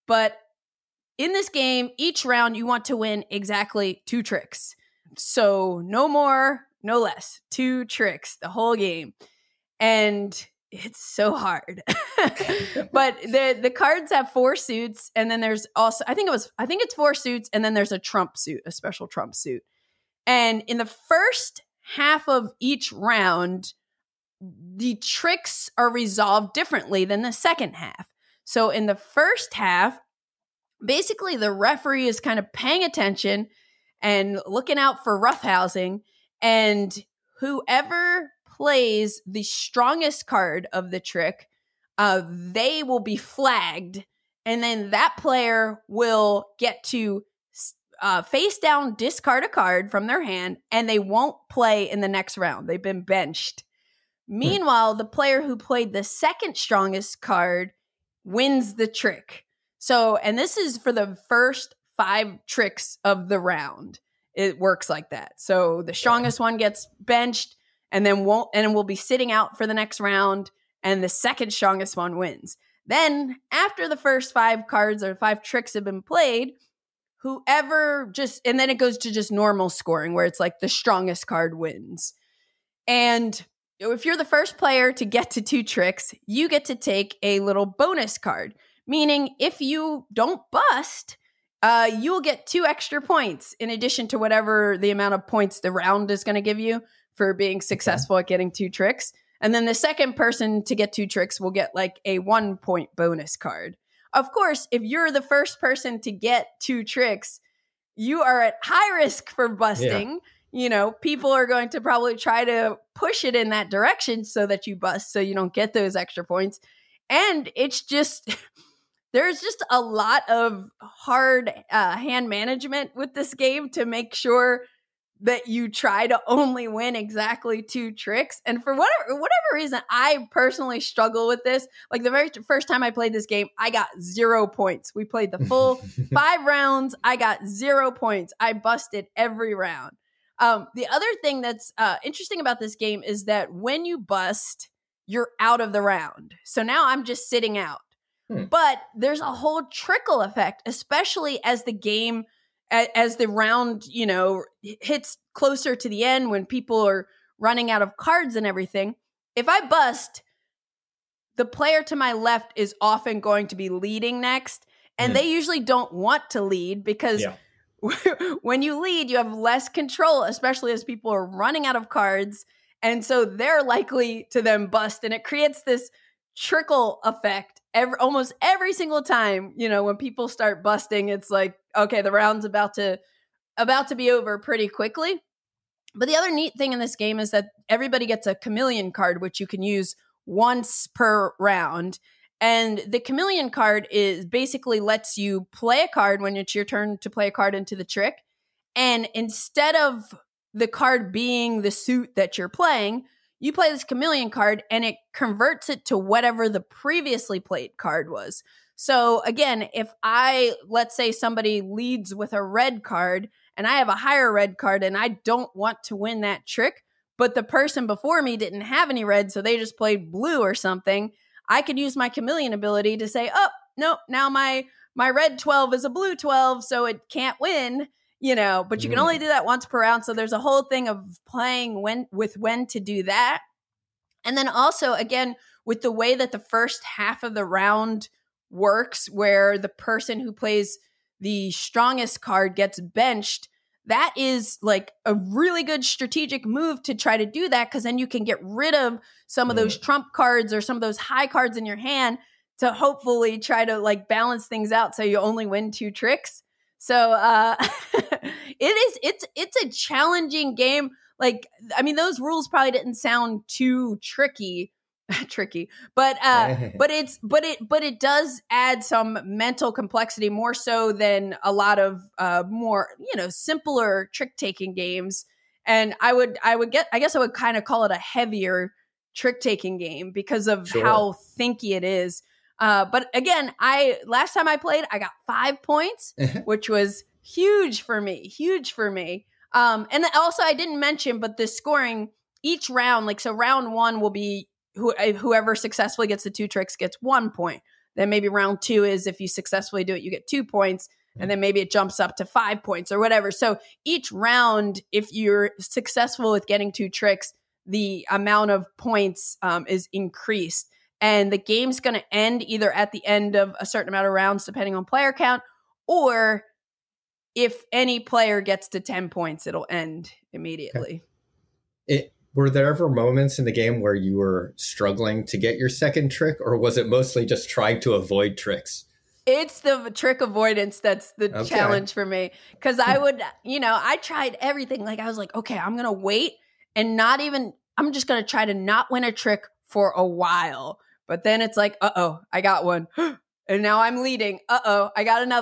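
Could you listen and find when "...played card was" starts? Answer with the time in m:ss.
3:27.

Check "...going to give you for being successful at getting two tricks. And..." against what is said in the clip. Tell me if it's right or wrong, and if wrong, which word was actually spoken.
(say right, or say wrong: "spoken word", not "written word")
right.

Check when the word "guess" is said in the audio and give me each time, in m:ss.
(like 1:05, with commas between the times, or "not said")
4:37.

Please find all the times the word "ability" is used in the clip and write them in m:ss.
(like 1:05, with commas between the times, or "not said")
3:42.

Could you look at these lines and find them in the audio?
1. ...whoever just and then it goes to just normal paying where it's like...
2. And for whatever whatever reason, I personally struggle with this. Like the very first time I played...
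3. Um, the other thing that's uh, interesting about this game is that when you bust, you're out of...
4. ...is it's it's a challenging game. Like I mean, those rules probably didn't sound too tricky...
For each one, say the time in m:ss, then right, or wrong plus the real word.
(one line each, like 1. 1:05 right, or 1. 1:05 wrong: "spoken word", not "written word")
1. 1:17 wrong: "scoring", not "paying"
2. 2:08 right
3. 2:20 right
4. 4:18 right.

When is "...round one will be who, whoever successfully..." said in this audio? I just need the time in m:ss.
4:53.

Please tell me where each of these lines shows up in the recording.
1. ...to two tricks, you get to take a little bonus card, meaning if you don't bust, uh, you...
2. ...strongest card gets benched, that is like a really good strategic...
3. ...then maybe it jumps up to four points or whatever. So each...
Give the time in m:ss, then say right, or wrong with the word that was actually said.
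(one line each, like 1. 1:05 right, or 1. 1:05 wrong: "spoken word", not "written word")
1. 1:25 right
2. 4:01 right
3. 5:01 wrong: "five", not "four".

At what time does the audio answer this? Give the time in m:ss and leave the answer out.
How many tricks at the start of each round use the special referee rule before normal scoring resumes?
1:01.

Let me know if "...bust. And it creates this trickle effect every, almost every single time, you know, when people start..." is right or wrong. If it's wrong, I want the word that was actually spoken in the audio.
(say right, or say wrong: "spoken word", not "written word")
right.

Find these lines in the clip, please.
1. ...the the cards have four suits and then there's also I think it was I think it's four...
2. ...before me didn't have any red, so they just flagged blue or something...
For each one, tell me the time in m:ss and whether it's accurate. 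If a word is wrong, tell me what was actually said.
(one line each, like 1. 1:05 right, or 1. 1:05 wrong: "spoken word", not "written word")
1. 0:13 right
2. 3:37 wrong: "played", not "flagged".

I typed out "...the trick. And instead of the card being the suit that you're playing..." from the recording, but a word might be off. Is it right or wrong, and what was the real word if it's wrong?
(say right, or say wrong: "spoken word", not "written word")
right.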